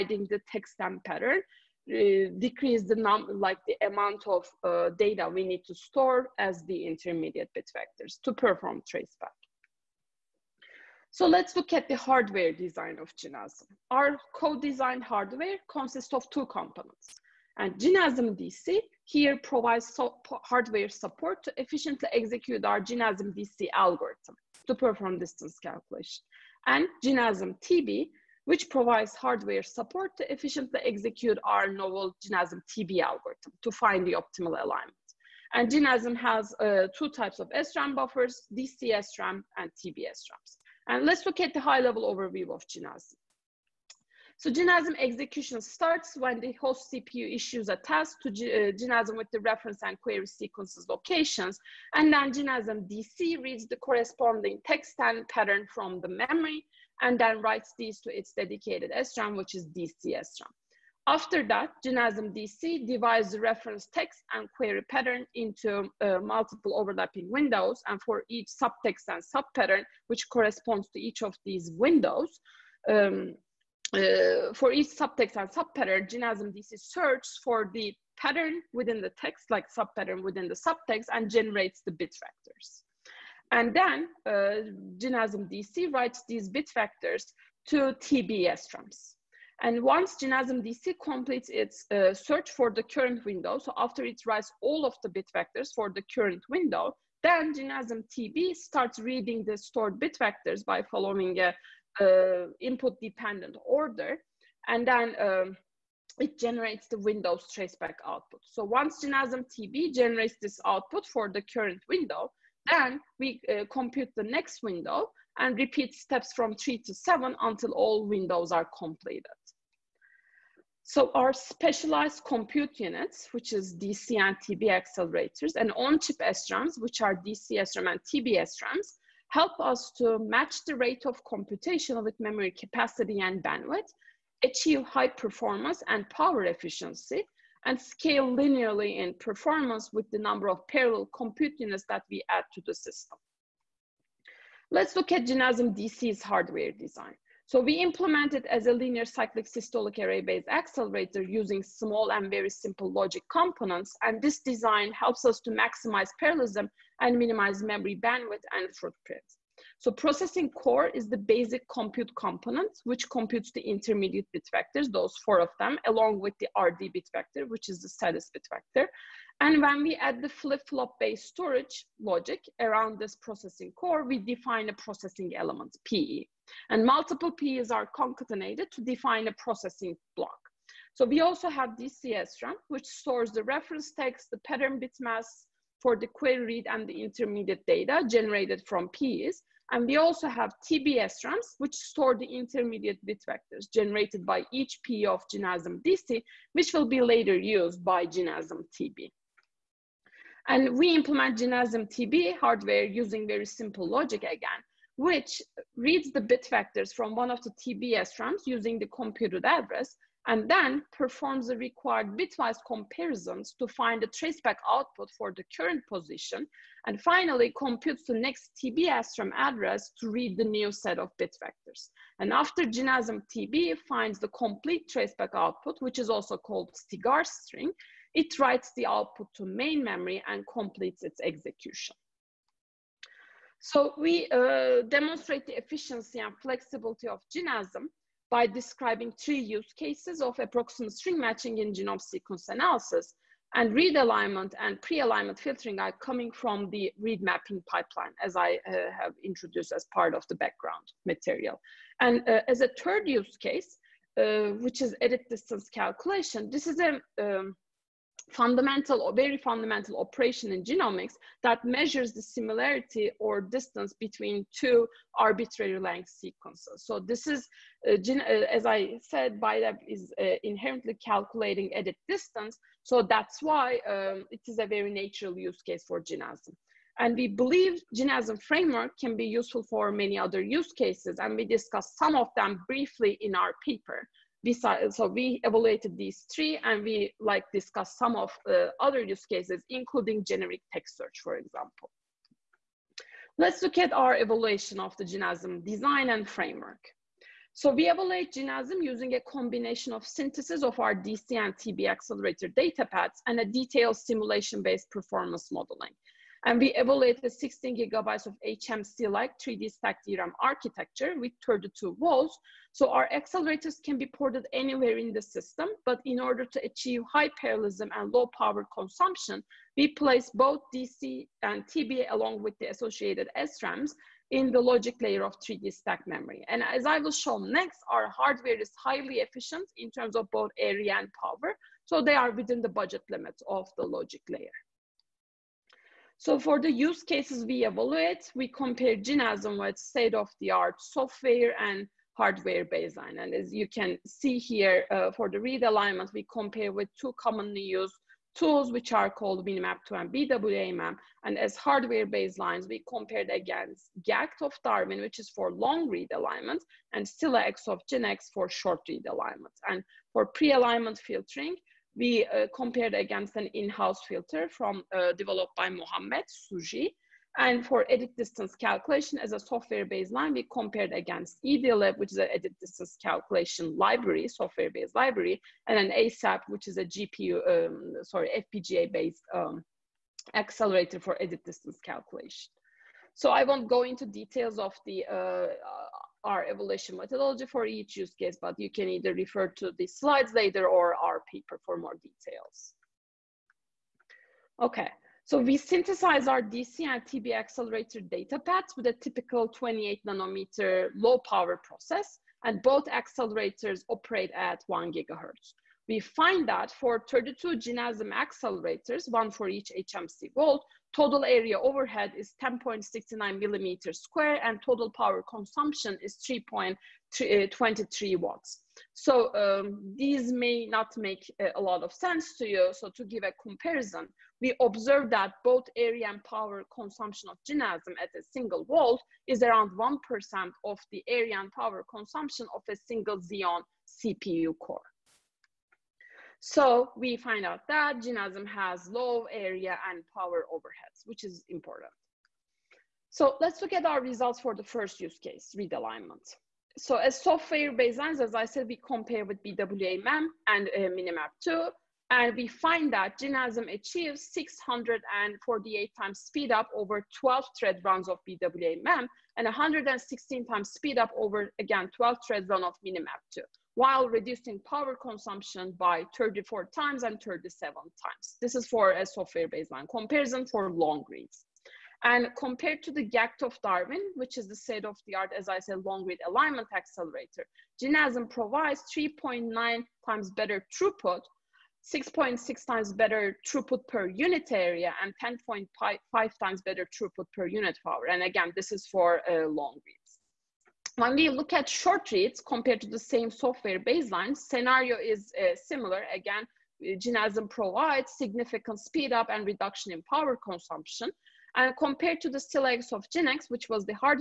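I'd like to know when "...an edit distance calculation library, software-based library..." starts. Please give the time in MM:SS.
06:12.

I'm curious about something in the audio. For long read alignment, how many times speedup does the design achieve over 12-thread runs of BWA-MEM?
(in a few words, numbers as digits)
648.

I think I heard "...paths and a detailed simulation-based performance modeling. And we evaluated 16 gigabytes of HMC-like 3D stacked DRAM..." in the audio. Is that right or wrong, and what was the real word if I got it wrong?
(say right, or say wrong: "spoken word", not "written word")
right.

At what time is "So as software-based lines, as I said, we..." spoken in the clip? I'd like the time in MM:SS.
07:26.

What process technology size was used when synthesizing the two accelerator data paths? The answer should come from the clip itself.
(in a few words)
28 nanometer.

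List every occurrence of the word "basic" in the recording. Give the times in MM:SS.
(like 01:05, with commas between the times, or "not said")
02:41.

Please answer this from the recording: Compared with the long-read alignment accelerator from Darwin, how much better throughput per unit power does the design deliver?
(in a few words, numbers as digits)
10.5 times.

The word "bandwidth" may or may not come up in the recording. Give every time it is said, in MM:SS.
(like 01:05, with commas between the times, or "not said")
02:13, 02:38.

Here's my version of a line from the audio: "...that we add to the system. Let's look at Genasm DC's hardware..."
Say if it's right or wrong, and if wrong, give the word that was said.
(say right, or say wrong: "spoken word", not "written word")
right.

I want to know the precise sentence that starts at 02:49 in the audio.
And when we add the flip-flop based storage logic around this processing core, we define a processing element, PE.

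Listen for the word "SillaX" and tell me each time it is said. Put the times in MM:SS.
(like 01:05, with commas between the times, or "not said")
05:57, 08:22.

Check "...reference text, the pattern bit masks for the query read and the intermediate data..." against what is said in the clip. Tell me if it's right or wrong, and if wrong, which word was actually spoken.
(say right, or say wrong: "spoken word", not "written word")
right.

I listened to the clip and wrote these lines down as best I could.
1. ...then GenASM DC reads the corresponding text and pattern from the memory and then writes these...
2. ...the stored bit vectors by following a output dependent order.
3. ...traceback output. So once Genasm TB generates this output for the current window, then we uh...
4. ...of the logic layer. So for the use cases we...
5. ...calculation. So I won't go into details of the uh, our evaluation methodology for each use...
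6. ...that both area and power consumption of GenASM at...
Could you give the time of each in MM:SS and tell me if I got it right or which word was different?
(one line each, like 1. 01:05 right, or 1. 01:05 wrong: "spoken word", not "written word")
1. 00:52 right
2. 01:39 wrong: "input", not "output"
3. 01:47 right
4. 05:33 right
5. 06:21 right
6. 07:05 right.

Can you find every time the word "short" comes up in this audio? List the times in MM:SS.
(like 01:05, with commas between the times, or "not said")
05:58, 08:11.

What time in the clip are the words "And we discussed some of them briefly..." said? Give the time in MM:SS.
04:41.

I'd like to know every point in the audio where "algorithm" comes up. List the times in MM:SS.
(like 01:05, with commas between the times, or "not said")
00:23, 00:33.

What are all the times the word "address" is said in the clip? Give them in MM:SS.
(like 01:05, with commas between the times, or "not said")
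03:29, 03:39.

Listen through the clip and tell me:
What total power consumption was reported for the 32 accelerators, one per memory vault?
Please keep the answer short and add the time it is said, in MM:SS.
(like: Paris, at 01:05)
3.23 watts, at 06:56.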